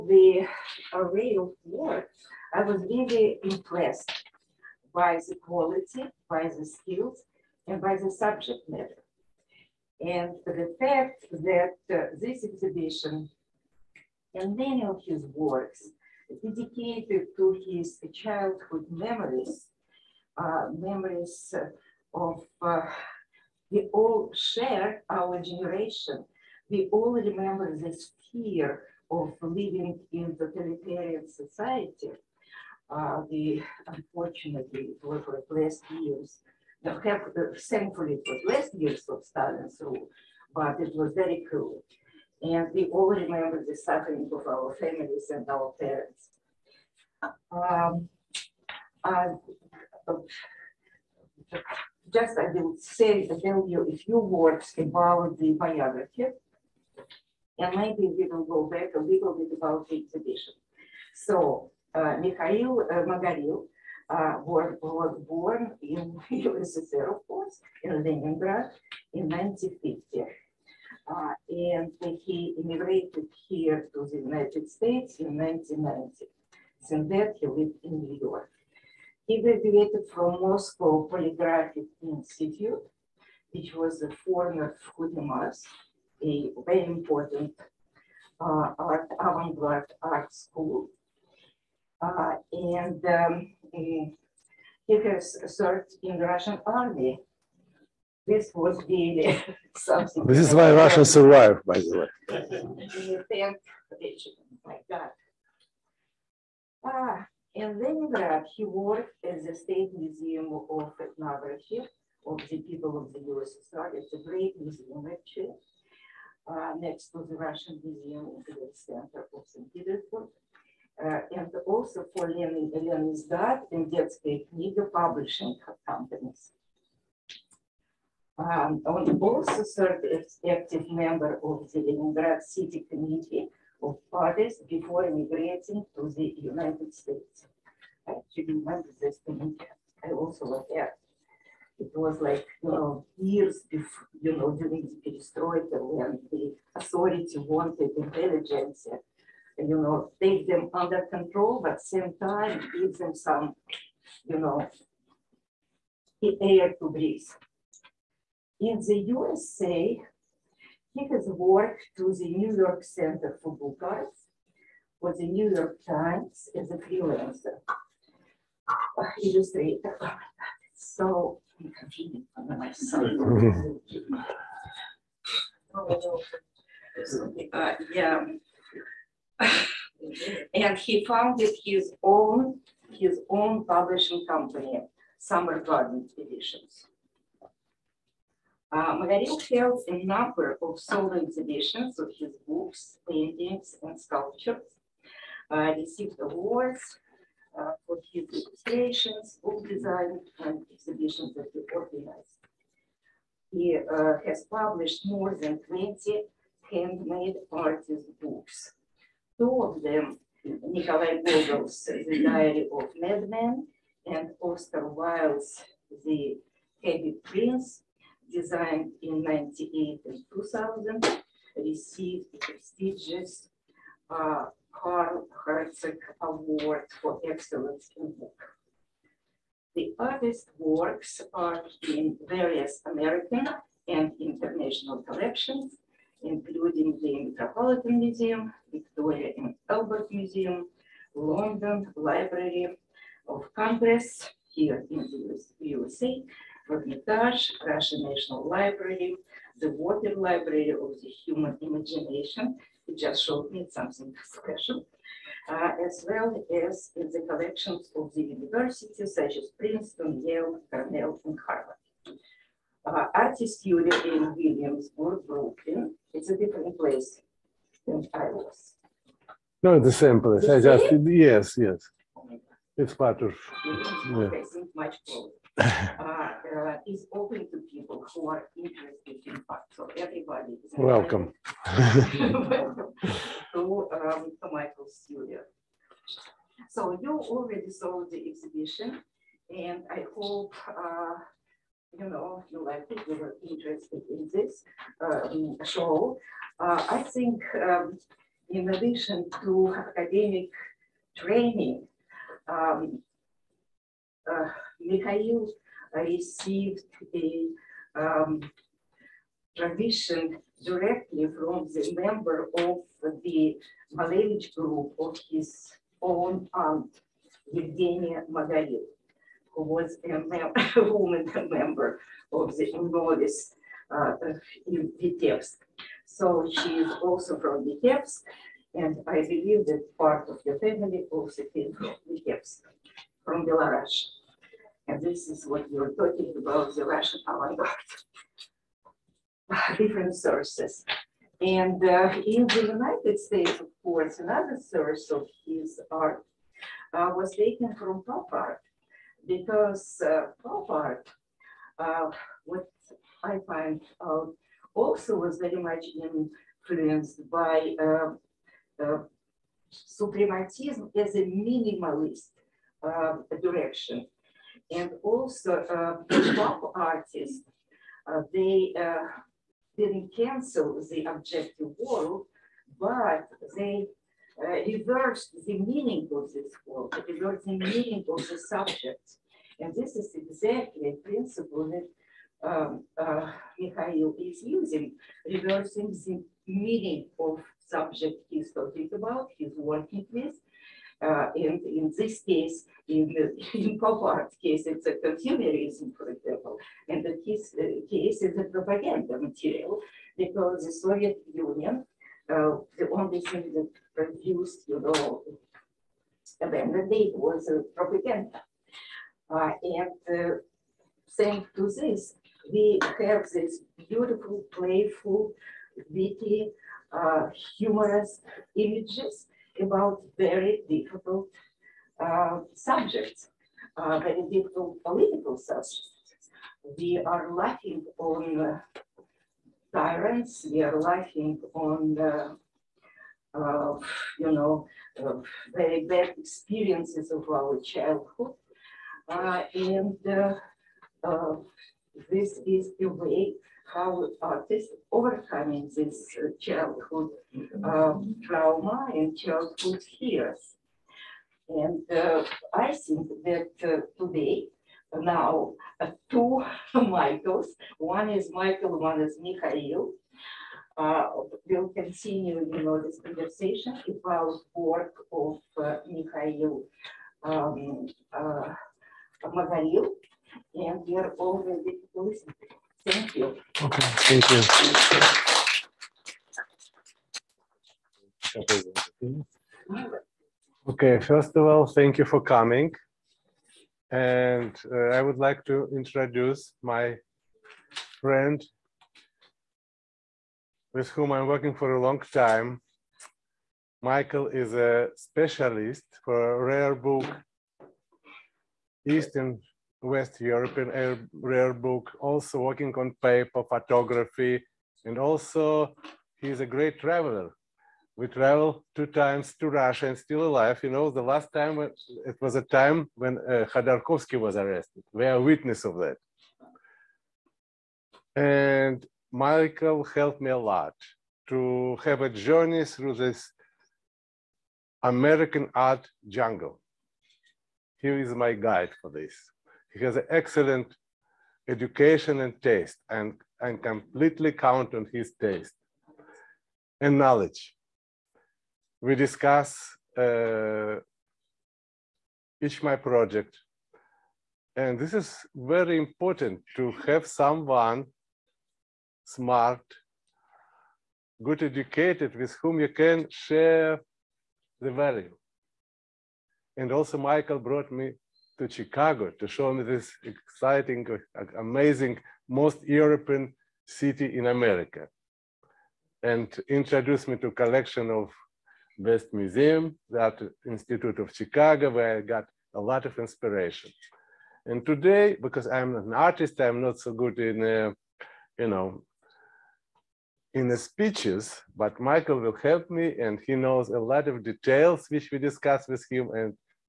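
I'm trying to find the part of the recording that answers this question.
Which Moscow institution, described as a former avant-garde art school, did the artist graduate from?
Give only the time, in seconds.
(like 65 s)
80 s.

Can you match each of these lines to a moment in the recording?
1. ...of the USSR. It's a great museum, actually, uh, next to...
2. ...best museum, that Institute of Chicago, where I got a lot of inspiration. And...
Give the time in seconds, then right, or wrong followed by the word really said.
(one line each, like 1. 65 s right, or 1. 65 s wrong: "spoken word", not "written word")
1. 112 s right
2. 568 s right.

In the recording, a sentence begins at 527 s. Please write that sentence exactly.
He is my guide for this.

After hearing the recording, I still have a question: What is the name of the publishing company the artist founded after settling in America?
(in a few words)
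Summer Garden Editions.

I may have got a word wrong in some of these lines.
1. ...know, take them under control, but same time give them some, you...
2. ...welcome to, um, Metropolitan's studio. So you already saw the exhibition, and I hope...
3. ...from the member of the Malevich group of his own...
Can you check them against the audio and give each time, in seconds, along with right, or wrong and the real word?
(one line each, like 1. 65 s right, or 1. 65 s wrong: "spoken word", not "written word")
1. 149 s right
2. 281 s wrong: "Michael", not "Metropolitan"
3. 311 s right.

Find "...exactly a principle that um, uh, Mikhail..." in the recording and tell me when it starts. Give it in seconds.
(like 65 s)
380 s.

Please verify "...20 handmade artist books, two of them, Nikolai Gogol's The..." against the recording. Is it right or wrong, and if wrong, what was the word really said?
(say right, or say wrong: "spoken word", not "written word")
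right.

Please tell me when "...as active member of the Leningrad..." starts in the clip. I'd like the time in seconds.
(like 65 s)
130 s.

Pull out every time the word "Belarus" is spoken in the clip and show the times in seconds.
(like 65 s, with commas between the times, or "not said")
333 s.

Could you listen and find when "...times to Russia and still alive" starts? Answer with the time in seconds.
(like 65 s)
508 s.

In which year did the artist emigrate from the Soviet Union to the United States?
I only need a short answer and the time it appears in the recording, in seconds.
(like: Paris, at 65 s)
1990, at 75 s.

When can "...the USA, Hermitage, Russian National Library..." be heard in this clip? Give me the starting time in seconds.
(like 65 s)
244 s.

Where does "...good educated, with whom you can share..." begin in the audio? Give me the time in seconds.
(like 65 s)
551 s.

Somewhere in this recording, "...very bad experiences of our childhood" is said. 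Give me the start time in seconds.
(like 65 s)
435 s.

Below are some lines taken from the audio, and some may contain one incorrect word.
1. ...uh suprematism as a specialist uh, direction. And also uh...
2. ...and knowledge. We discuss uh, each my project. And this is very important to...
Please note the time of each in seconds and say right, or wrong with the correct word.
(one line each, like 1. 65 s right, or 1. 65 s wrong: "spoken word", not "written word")
1. 358 s wrong: "minimalist", not "specialist"
2. 536 s right.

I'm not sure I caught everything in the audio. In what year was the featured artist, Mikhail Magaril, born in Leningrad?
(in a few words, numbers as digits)
1950.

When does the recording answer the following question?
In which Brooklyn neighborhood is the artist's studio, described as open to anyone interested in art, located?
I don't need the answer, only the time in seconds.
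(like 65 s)
264 s.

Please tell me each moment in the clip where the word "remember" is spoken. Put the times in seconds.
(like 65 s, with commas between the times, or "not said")
27 s, 43 s, 138 s.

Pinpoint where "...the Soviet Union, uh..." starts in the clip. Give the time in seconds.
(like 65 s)
400 s.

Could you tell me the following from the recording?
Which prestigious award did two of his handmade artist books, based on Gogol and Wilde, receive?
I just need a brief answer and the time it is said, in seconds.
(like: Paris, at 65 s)
Carl Hertzog Award, at 224 s.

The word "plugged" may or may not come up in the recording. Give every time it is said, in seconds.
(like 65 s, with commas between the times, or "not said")
not said.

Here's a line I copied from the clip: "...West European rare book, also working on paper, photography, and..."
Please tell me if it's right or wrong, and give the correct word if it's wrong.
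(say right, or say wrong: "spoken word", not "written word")
right.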